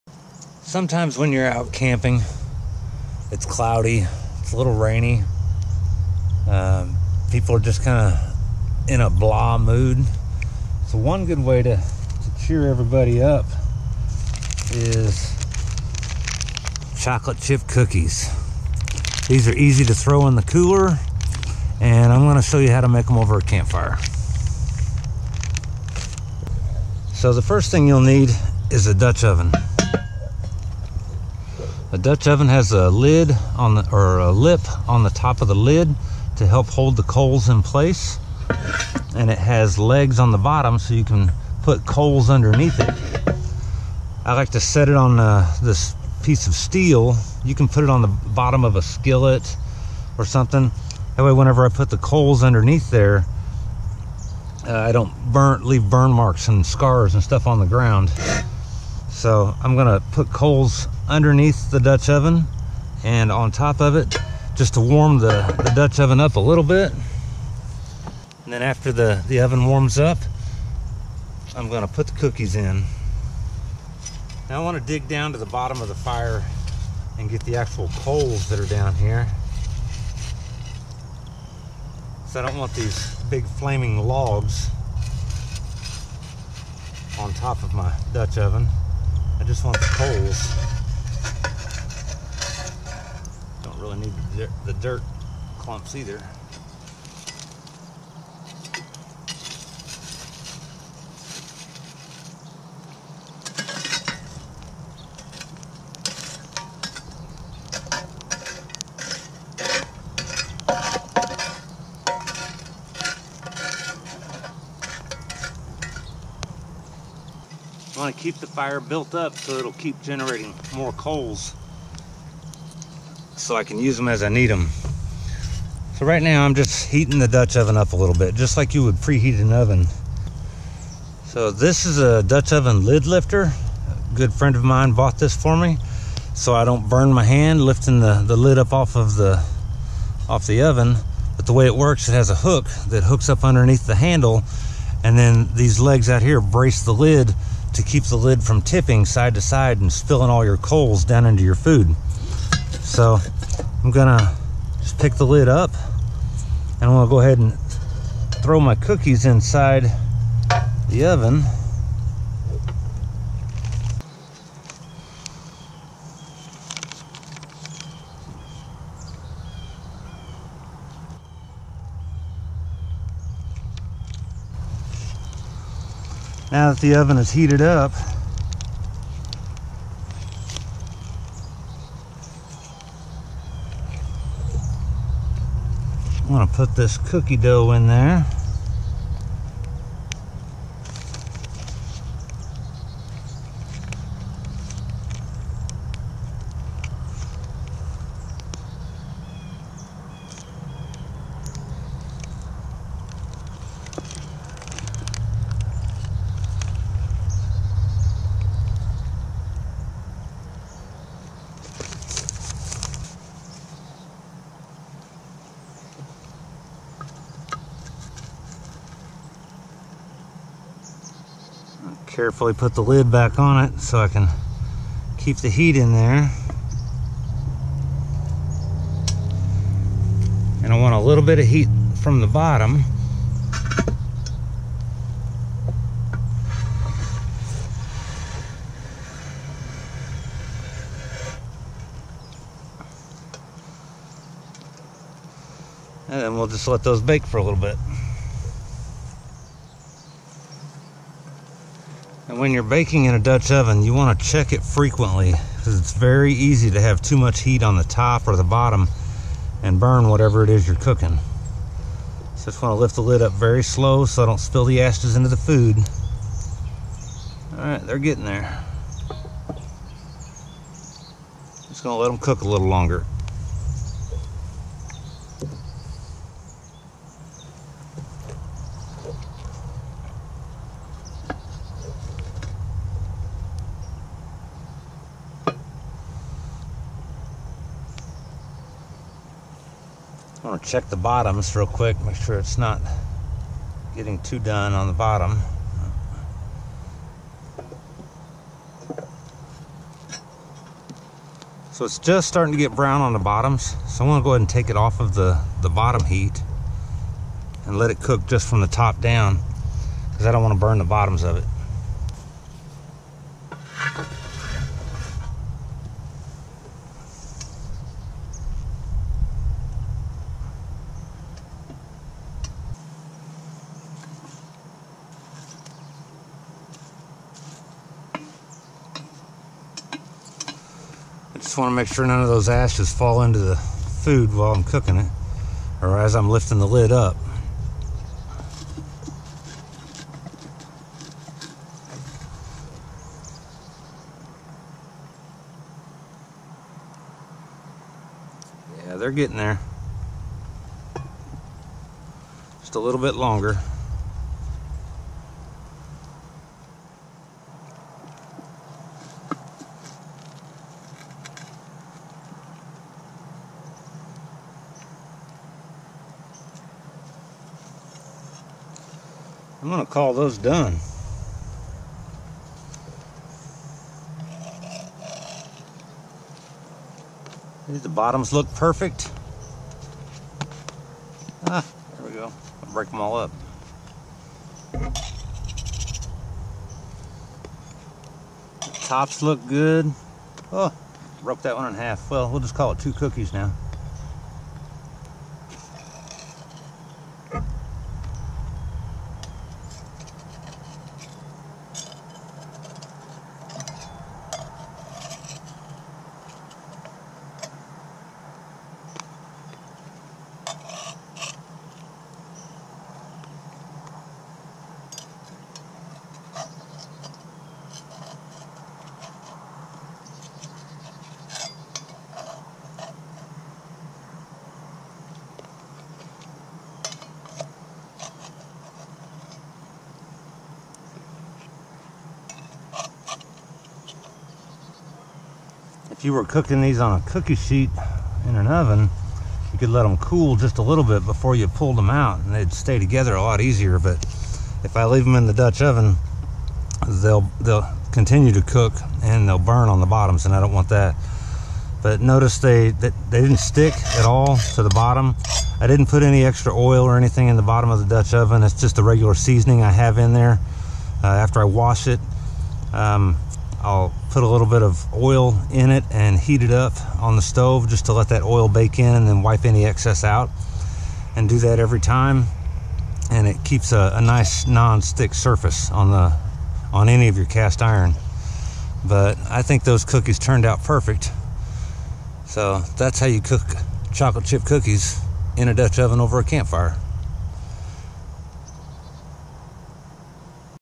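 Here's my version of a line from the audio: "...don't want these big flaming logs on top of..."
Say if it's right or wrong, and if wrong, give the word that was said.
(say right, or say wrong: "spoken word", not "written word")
right.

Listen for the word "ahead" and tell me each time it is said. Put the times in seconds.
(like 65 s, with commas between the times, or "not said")
157 s, 304 s.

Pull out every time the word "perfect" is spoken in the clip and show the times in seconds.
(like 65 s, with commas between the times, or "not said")
378 s, 480 s.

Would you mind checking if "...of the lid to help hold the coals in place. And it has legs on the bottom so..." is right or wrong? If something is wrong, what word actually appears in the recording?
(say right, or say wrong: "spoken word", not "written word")
right.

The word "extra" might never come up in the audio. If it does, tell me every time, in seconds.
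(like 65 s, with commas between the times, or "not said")
456 s.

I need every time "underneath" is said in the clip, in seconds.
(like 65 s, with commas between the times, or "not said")
42 s, 52 s, 61 s, 143 s.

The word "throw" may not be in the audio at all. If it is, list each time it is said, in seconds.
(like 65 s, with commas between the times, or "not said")
19 s, 158 s.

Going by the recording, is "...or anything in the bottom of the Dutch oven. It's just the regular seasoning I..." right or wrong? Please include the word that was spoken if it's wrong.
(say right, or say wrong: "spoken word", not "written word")
right.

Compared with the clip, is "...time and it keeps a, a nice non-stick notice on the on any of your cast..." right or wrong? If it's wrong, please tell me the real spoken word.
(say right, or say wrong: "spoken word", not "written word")
wrong: "surface", not "notice".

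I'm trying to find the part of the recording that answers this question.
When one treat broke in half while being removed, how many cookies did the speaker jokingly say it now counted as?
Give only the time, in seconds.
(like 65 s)
392 s.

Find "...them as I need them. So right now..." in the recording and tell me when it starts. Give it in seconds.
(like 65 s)
123 s.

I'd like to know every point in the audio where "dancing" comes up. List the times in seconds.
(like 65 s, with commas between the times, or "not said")
not said.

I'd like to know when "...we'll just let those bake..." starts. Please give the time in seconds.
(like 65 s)
246 s.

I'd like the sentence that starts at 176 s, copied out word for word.
Now that the oven is heated up, I'm gonna put this cookie dough in there.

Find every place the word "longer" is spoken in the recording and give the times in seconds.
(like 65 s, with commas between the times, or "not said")
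272 s, 353 s.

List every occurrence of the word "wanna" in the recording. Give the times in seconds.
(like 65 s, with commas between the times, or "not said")
74 s, 310 s.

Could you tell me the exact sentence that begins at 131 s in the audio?
So this is a Dutch oven lid lifter.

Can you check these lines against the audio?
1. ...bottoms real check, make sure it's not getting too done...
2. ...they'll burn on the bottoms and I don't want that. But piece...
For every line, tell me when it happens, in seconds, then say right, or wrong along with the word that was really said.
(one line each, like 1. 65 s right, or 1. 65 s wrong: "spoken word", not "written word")
1. 290 s wrong: "quick", not "check"
2. 449 s wrong: "notice", not "piece".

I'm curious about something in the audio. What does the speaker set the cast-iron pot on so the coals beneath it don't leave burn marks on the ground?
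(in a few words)
piece of steel.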